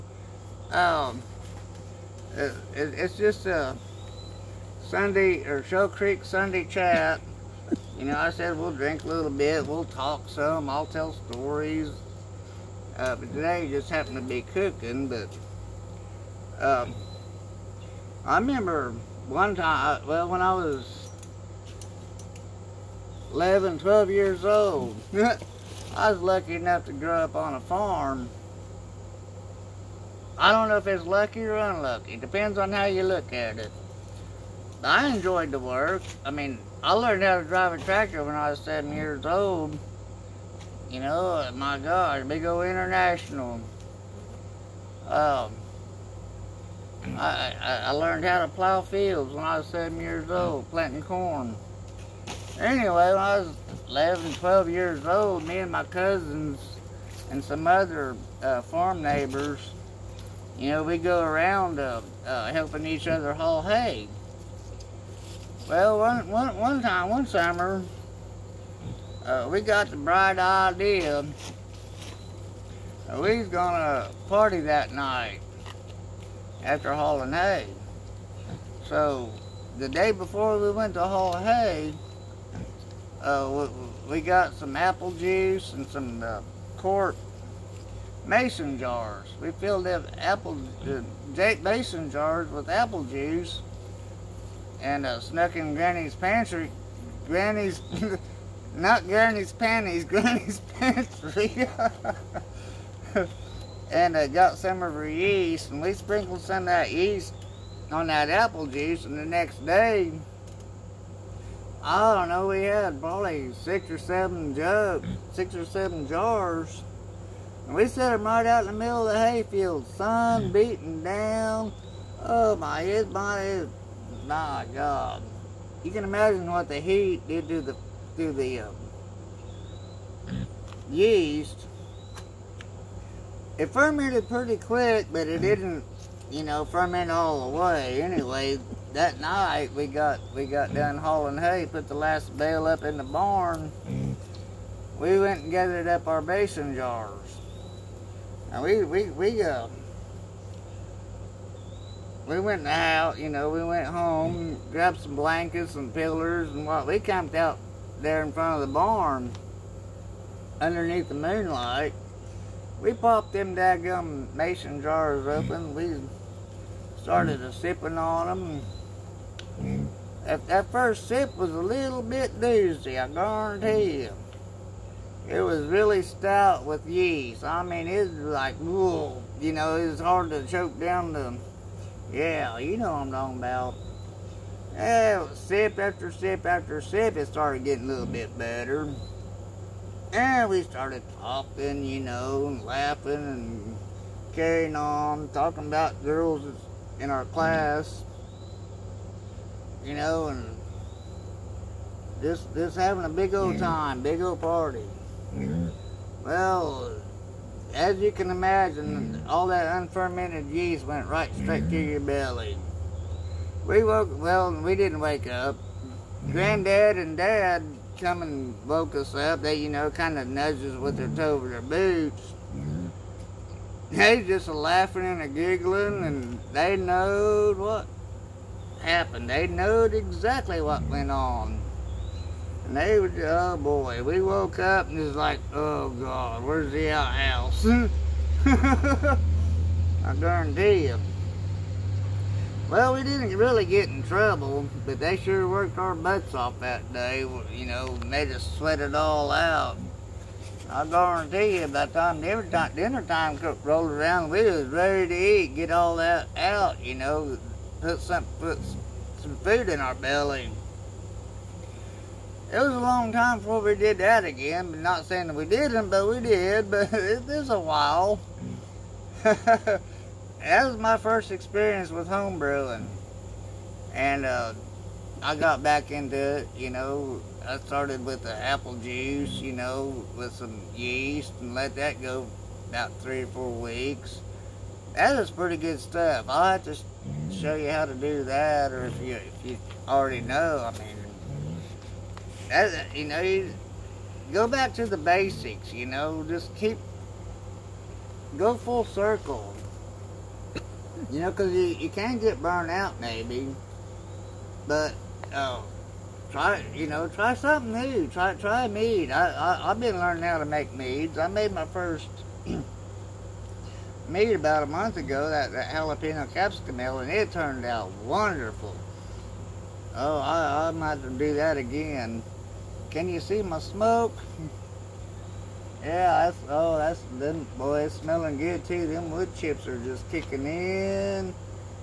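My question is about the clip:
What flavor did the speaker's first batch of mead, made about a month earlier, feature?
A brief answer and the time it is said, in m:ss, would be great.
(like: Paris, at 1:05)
jalapeno capsicum, at 5:15.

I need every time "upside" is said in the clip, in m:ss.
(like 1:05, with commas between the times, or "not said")
not said.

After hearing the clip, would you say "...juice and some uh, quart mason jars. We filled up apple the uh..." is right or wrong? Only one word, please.
right.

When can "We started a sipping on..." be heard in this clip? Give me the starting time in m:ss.
2:45.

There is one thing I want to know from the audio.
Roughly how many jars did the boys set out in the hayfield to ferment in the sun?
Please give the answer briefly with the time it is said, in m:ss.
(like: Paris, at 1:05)
6 or 7, at 1:55.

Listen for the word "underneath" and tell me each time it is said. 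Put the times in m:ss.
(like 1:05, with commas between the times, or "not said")
2:40.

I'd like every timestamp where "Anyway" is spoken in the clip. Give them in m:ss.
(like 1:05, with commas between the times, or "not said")
0:52, 2:18.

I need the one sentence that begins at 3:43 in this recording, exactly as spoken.
They just laughing and a giggling, and they knowed what happened.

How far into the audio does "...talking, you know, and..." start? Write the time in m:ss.
3:11.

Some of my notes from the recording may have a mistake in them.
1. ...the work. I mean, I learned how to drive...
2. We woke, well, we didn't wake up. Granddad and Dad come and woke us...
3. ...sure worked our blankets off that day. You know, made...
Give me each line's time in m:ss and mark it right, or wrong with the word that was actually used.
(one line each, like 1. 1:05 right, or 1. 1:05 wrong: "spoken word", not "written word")
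1. 0:35 right
2. 3:33 right
3. 4:05 wrong: "butts", not "blankets".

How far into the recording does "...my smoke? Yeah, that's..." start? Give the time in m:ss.
5:23.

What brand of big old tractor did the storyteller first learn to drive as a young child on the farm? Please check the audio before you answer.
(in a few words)
International.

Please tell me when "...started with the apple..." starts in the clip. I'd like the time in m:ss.
4:37.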